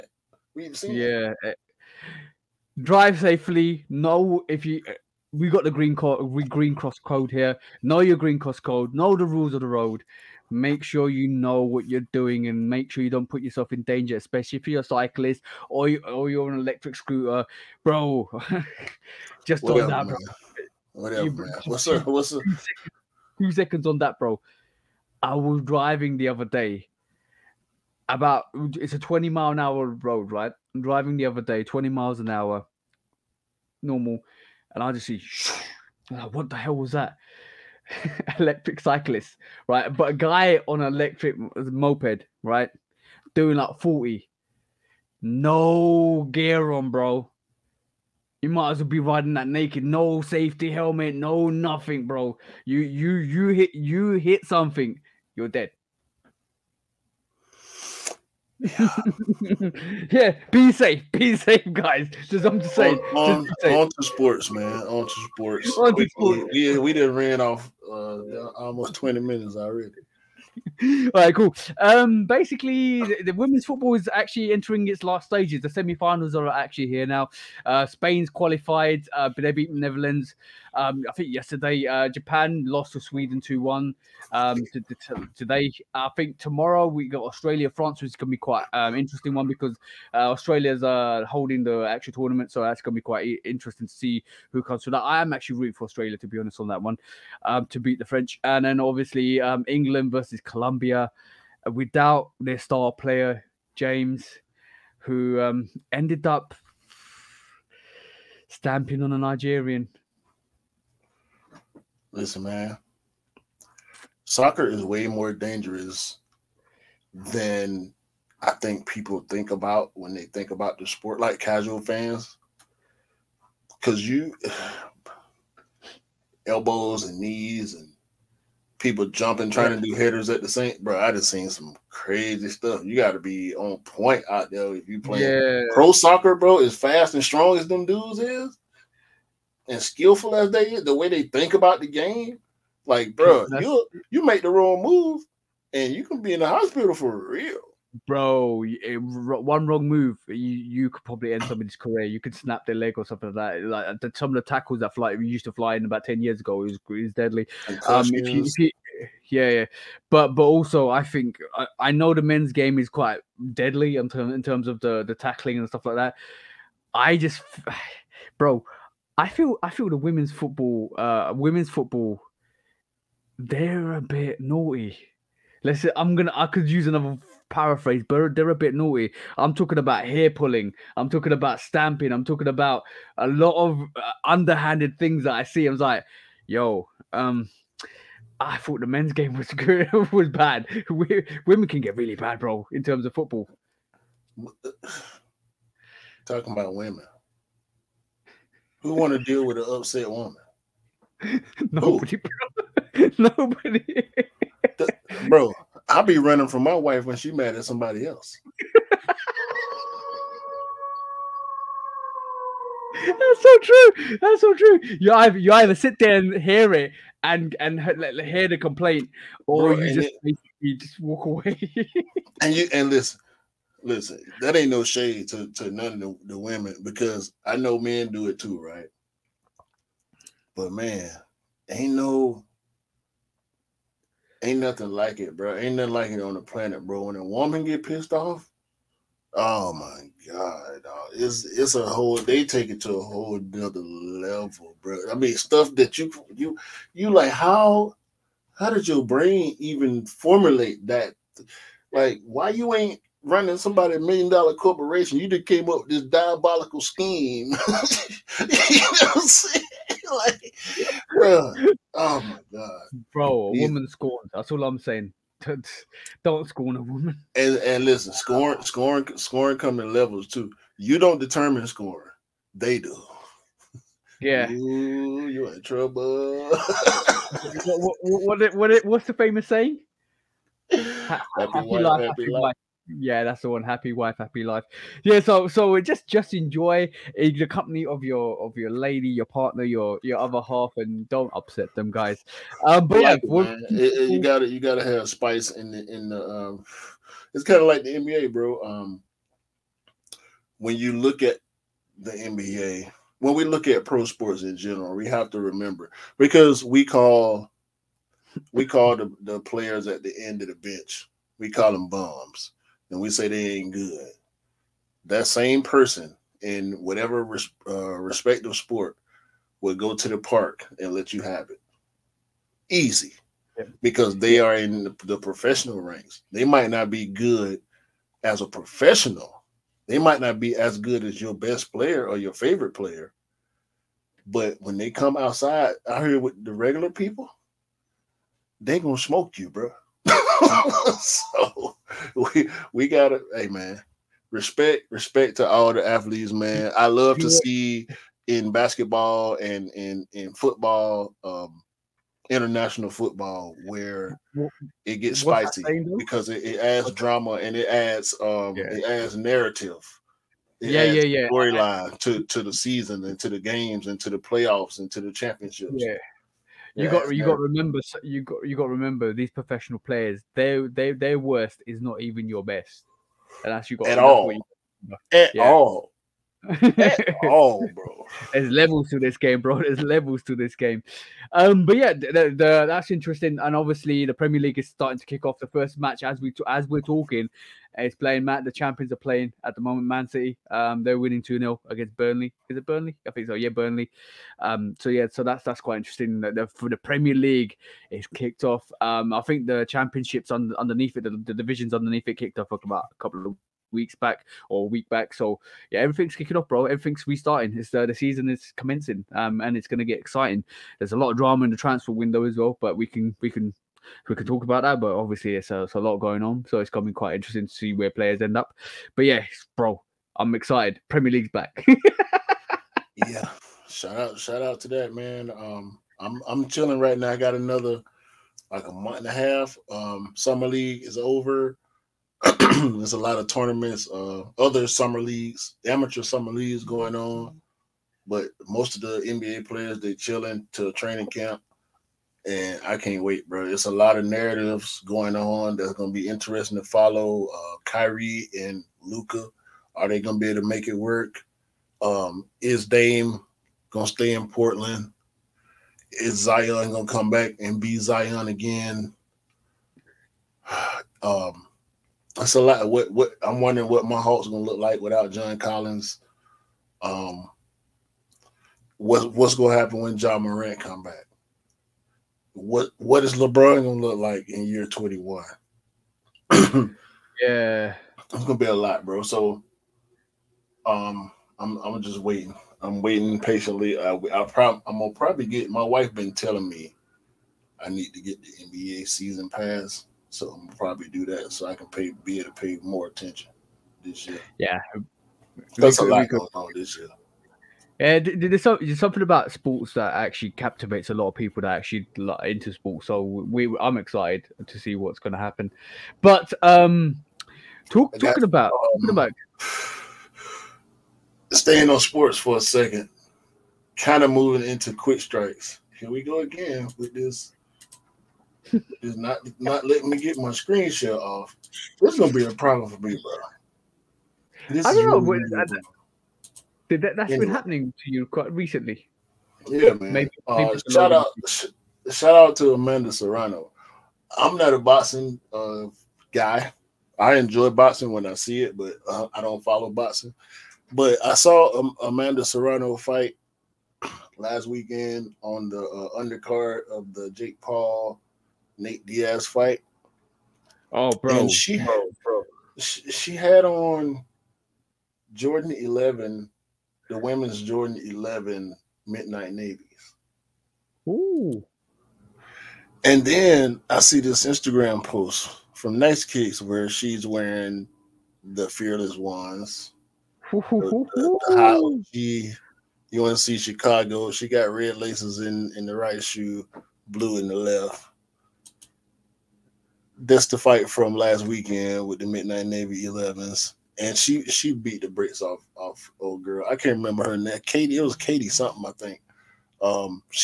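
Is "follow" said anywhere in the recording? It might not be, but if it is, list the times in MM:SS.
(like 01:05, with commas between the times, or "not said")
07:26, 08:59.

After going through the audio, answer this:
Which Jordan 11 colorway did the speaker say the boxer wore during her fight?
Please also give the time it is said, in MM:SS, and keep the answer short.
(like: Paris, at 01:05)
Midnight Navy, at 09:18.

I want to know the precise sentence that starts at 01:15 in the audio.
The semi-finals are actually here now.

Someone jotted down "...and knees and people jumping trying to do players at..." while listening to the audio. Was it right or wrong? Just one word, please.
wrong.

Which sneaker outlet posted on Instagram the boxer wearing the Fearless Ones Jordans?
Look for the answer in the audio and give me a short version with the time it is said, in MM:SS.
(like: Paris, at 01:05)
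Nice Kicks, at 09:25.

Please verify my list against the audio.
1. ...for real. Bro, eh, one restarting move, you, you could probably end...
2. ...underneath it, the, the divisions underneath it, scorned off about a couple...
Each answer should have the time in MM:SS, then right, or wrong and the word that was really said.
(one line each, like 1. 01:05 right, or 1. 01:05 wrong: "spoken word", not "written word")
1. 02:26 wrong: "wrong", not "restarting"
2. 06:40 wrong: "kicked", not "scorned".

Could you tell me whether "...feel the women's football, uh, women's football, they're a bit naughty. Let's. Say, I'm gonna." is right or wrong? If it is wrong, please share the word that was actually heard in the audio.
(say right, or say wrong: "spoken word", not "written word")
right.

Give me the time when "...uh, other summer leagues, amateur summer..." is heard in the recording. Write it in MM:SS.
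07:13.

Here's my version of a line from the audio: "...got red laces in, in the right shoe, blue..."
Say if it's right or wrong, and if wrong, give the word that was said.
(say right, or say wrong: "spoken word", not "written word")
right.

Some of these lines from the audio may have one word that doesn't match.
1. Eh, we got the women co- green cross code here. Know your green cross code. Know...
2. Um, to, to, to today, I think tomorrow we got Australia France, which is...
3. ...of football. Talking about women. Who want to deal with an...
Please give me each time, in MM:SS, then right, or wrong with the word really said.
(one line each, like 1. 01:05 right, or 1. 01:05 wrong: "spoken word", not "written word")
1. 00:04 wrong: "green", not "women"
2. 01:24 right
3. 03:13 right.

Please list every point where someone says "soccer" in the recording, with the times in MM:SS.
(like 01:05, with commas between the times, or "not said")
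01:54, 02:15.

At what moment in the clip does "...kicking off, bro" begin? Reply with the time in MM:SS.
06:46.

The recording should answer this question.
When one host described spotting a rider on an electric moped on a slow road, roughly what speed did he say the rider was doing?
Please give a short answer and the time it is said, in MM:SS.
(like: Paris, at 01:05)
40, at 00:43.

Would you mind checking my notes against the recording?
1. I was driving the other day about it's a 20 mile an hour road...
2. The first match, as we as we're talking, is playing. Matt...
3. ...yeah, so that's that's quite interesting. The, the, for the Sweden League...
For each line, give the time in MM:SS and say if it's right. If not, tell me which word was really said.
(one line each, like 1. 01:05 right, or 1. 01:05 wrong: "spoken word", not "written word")
1. 00:25 right
2. 06:25 right
3. 06:34 wrong: "Premier", not "Sweden".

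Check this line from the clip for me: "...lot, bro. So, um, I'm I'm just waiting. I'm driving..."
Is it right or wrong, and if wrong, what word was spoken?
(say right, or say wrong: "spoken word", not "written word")
wrong: "waiting", not "driving".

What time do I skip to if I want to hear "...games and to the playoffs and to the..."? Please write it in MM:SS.
06:03.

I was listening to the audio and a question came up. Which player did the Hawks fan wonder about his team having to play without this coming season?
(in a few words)
John Collins.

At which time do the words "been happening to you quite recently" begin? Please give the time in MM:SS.
08:47.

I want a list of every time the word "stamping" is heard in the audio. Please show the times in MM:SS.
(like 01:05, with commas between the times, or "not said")
01:48, 03:01.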